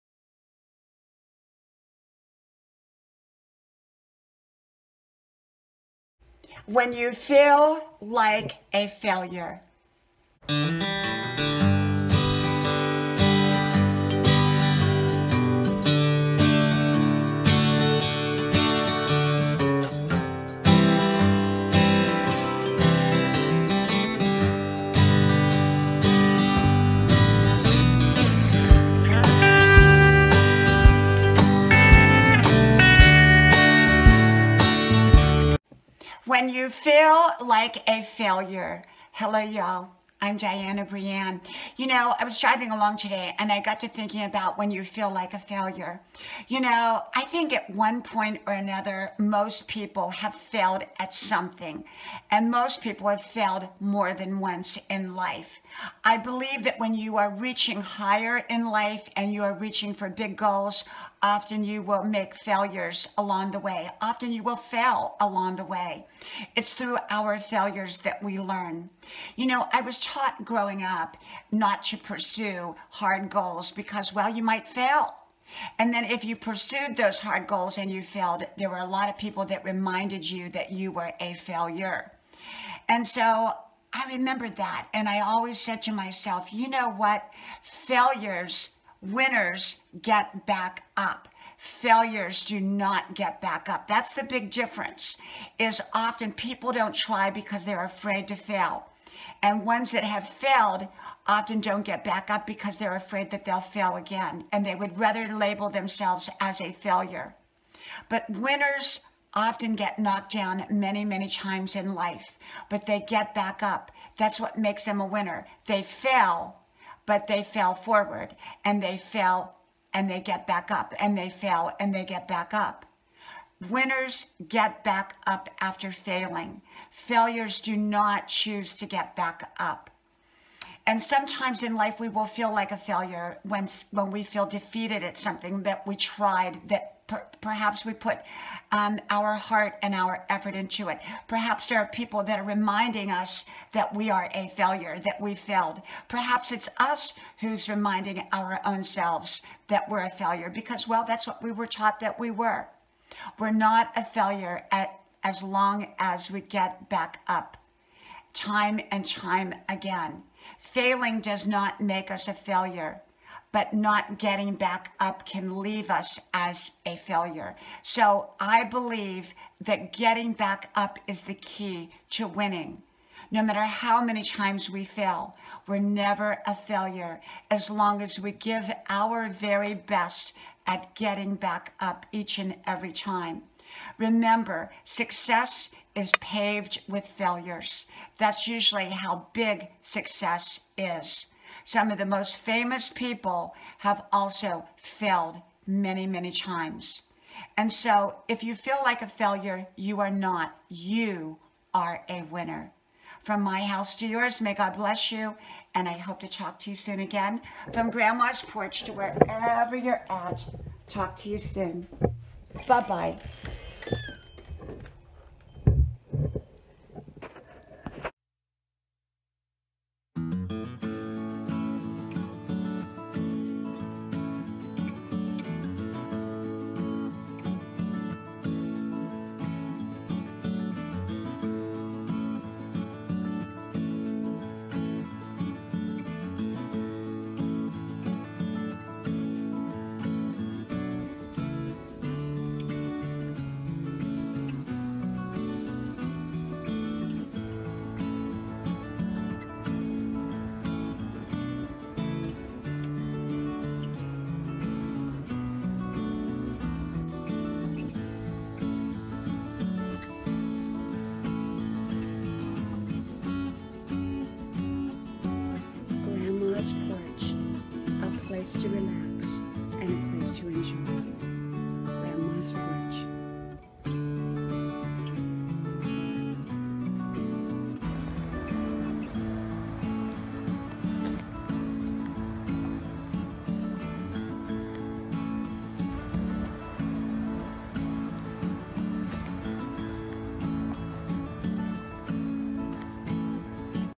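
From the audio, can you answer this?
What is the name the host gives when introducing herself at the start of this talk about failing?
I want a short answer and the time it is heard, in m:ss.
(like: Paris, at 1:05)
Dianna Brianne, at 0:40.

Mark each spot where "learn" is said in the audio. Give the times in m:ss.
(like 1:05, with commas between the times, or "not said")
1:08.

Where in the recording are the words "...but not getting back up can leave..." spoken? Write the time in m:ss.
2:43.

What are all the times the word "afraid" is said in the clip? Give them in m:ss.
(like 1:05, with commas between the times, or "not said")
1:37, 1:42.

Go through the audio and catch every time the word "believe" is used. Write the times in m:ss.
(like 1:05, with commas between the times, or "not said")
0:56, 2:48.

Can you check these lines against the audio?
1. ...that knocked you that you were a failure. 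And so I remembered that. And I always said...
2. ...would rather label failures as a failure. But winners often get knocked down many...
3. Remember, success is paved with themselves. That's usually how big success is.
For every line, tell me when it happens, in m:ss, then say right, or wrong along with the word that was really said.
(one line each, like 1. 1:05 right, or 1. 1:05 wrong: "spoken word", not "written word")
1. 1:19 wrong: "reminded", not "knocked"
2. 1:44 wrong: "themselves", not "failures"
3. 3:03 wrong: "failures", not "themselves".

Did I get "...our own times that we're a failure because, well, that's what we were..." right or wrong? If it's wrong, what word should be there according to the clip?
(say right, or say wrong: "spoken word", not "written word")
wrong: "selves", not "times".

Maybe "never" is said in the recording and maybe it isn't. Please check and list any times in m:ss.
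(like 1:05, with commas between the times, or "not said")
2:55.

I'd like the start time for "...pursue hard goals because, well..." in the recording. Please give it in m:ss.
1:11.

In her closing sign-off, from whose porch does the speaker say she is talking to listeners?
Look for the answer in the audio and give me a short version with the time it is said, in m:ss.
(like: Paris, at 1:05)
Grandma's porch, at 3:27.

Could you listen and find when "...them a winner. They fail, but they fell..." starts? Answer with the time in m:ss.
1:54.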